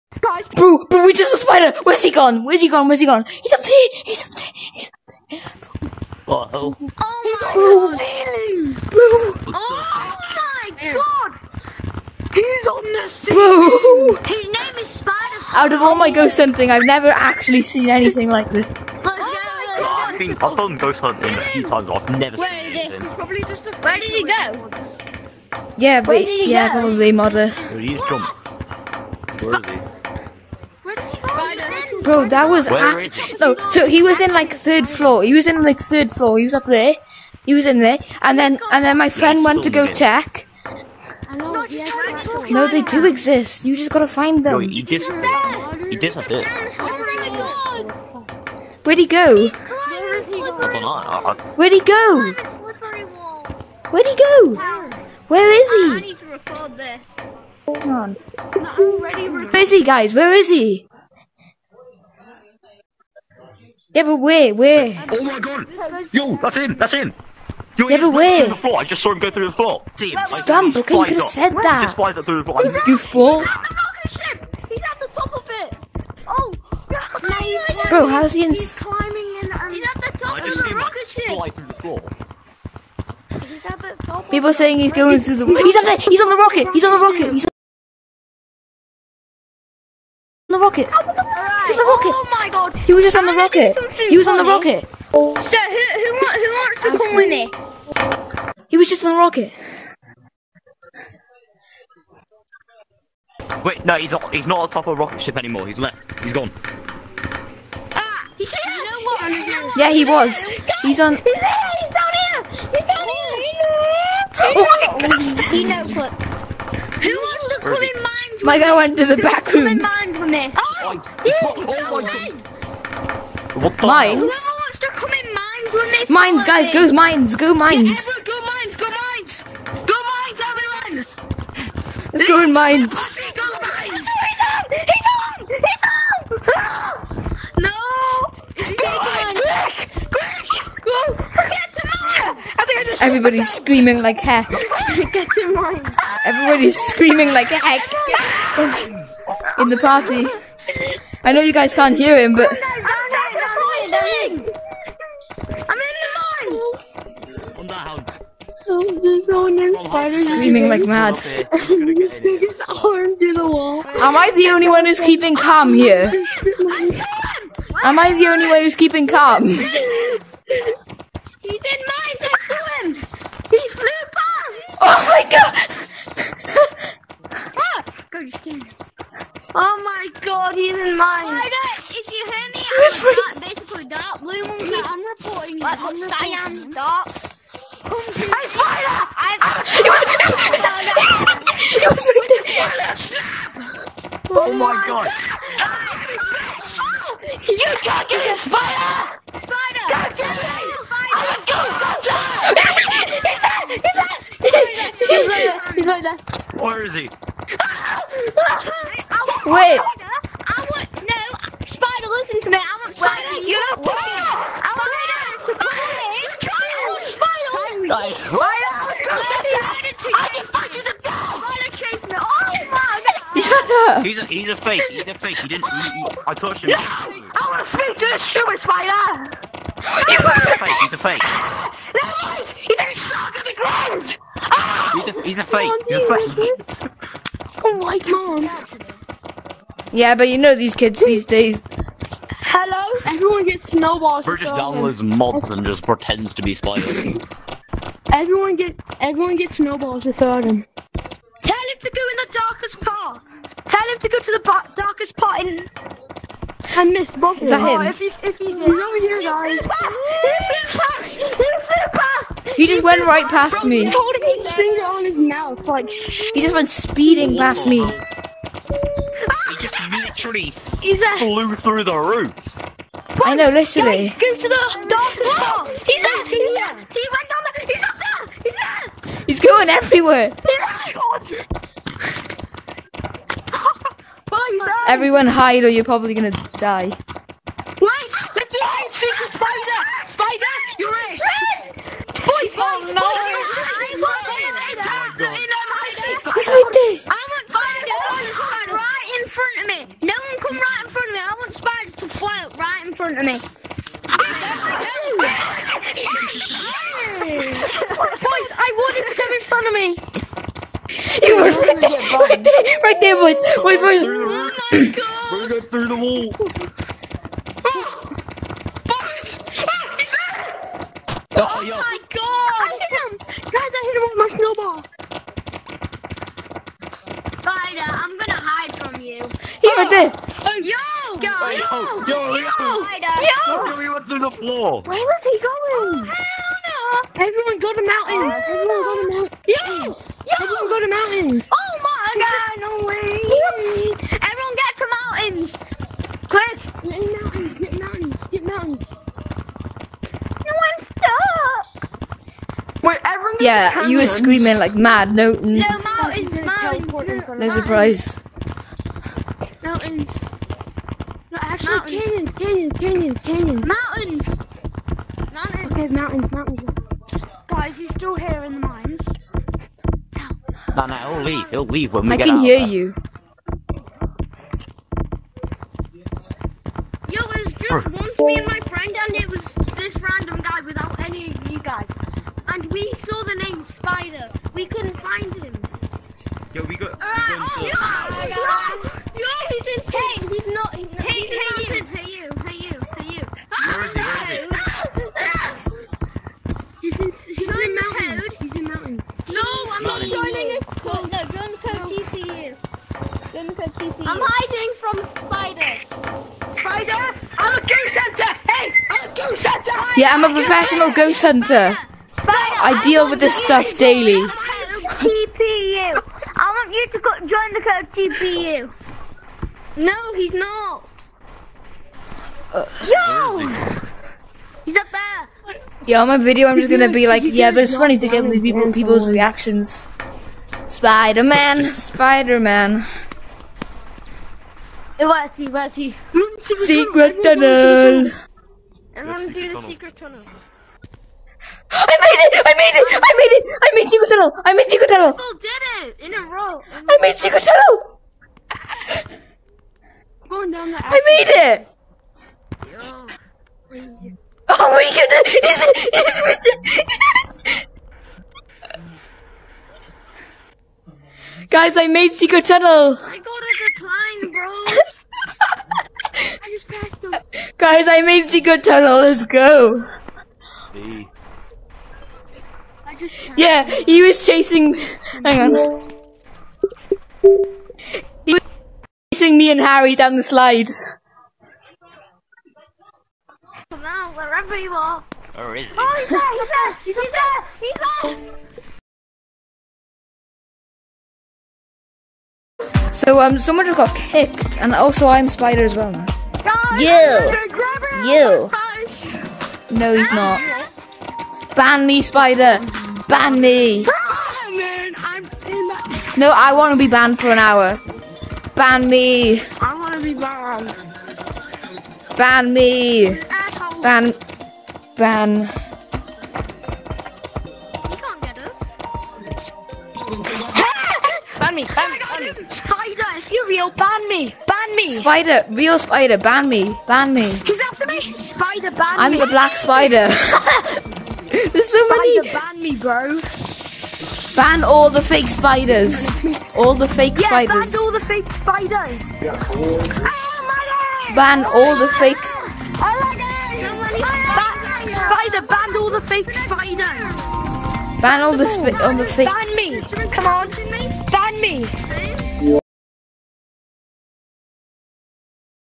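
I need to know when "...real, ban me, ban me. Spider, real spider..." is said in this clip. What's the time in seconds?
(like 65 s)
523 s.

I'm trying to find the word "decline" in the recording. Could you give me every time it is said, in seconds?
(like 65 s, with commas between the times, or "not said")
not said.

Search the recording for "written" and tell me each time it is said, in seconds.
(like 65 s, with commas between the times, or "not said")
not said.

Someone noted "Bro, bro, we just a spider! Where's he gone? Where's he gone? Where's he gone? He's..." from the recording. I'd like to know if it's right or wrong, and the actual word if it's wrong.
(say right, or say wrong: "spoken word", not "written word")
right.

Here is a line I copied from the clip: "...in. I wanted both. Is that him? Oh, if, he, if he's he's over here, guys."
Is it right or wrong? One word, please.
wrong.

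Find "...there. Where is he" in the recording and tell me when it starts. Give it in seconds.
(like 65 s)
206 s.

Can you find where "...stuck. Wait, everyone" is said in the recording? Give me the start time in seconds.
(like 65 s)
350 s.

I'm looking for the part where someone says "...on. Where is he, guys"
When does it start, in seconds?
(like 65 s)
57 s.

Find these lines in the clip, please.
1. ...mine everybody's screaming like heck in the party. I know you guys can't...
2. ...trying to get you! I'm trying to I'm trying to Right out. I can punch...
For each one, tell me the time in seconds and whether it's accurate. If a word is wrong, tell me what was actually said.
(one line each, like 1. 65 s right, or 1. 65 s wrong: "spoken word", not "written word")
1. 145 s right
2. 212 s right.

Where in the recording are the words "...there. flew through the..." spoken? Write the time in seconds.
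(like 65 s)
270 s.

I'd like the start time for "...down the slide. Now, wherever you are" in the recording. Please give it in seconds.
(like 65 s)
479 s.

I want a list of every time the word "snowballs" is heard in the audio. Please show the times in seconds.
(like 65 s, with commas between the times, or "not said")
243 s, 249 s, 325 s.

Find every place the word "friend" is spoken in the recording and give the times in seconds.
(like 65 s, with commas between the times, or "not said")
39 s, 378 s.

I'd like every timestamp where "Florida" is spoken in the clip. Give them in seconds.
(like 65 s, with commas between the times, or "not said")
181 s.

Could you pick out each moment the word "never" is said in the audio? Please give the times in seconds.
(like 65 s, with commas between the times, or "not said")
16 s, 22 s.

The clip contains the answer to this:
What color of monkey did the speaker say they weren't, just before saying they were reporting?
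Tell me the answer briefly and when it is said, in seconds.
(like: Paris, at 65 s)
Dark blue, at 183 s.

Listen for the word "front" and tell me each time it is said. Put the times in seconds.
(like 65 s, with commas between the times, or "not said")
309 s.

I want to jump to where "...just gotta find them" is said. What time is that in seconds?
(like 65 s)
43 s.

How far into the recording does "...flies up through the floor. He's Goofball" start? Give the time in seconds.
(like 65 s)
71 s.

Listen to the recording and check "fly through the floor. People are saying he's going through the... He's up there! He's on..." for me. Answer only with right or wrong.
right.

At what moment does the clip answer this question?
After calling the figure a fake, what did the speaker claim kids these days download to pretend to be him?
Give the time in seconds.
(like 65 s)
245 s.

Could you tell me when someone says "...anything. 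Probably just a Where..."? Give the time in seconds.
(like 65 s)
22 s.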